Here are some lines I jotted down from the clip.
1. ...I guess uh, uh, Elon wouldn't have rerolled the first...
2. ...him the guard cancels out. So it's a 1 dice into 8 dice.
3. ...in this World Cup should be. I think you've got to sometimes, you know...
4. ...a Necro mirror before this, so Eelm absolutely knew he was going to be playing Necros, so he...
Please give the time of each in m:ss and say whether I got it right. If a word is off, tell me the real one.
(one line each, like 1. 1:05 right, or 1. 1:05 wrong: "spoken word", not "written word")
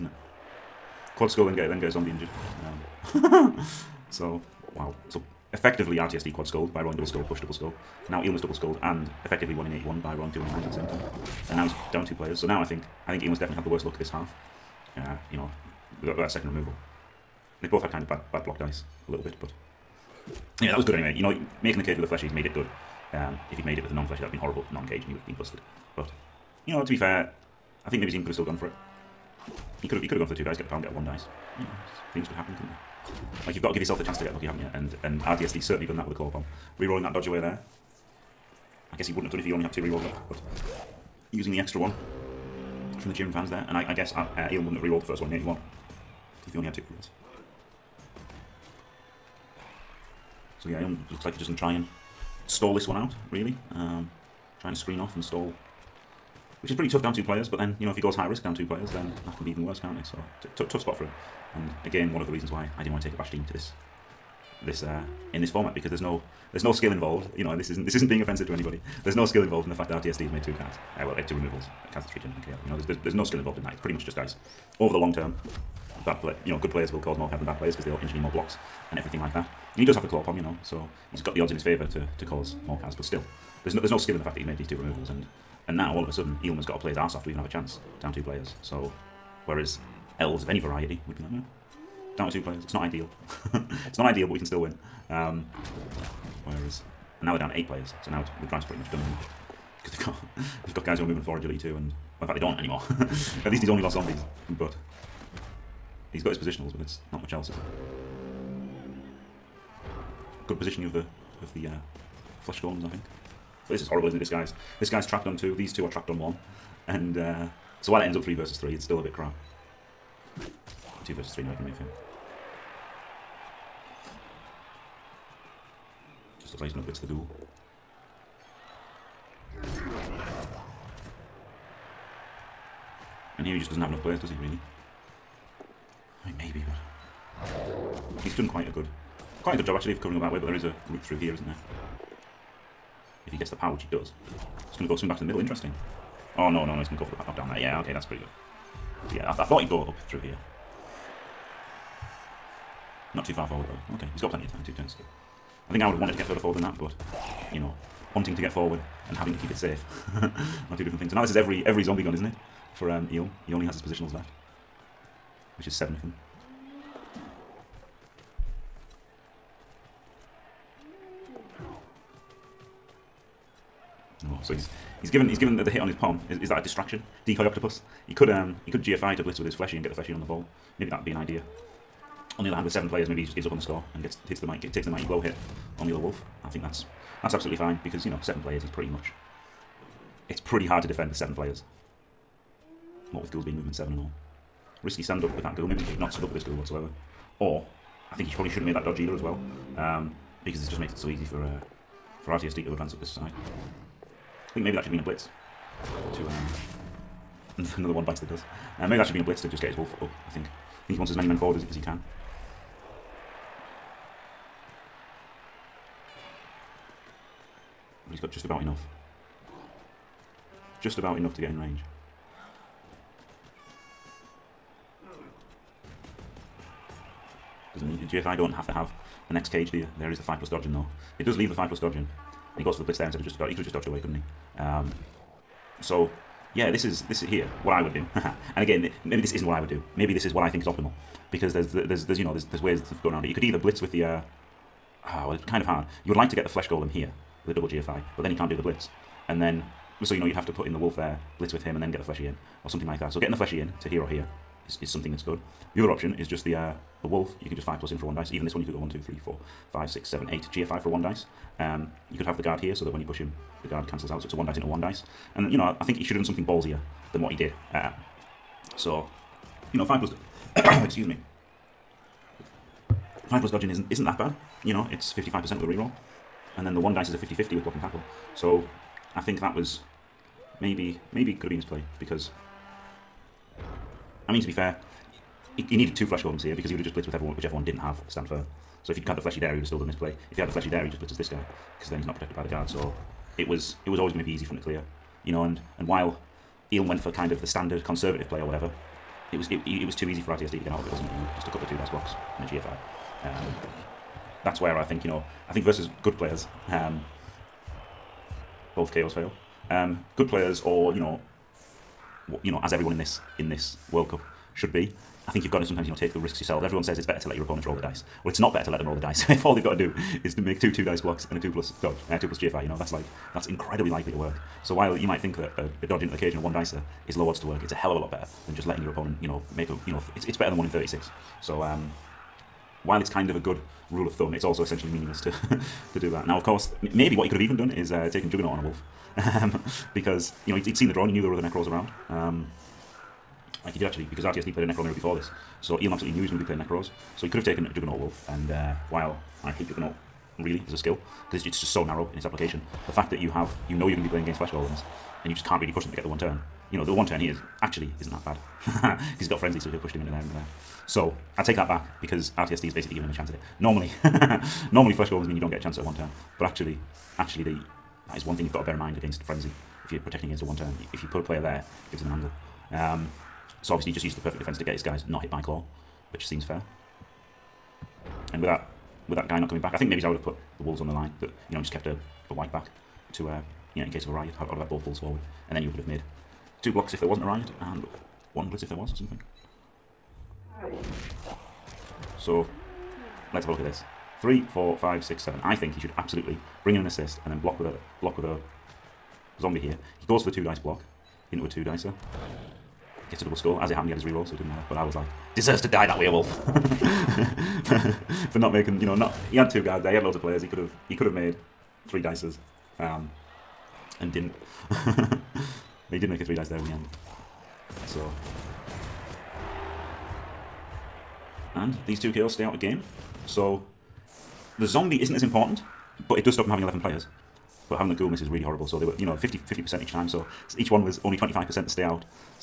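1. 0:43 right
2. 4:23 wrong: "1", not "8"
3. 5:13 right
4. 5:44 right.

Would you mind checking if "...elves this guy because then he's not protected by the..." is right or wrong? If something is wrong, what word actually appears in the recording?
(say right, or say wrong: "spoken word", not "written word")
wrong: "blitzes", not "elves".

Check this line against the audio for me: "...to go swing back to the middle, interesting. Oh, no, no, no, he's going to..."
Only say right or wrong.
right.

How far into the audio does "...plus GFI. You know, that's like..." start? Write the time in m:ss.
5:22.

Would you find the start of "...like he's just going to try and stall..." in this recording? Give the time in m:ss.
0:51.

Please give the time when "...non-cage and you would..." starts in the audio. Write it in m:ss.
0:24.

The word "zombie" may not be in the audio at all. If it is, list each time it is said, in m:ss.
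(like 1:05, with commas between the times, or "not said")
0:01, 1:43, 2:41, 6:39, 7:04.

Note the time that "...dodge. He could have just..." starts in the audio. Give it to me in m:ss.
3:53.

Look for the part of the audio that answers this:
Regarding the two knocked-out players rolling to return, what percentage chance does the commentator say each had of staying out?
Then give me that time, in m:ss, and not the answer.
7:11.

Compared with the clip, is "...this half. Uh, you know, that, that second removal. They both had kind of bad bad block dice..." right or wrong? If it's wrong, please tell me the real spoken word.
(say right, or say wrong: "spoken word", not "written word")
right.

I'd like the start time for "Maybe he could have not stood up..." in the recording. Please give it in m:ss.
3:15.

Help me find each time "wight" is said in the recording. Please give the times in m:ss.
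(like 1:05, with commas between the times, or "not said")
6:22.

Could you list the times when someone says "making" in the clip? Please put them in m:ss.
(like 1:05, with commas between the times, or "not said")
0:21, 6:48.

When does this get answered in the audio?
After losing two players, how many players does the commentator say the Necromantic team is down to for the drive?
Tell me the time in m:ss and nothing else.
1:37.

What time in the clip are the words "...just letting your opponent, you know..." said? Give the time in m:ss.
5:28.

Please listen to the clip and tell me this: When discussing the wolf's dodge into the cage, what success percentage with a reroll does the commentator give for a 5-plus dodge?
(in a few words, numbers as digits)
55%.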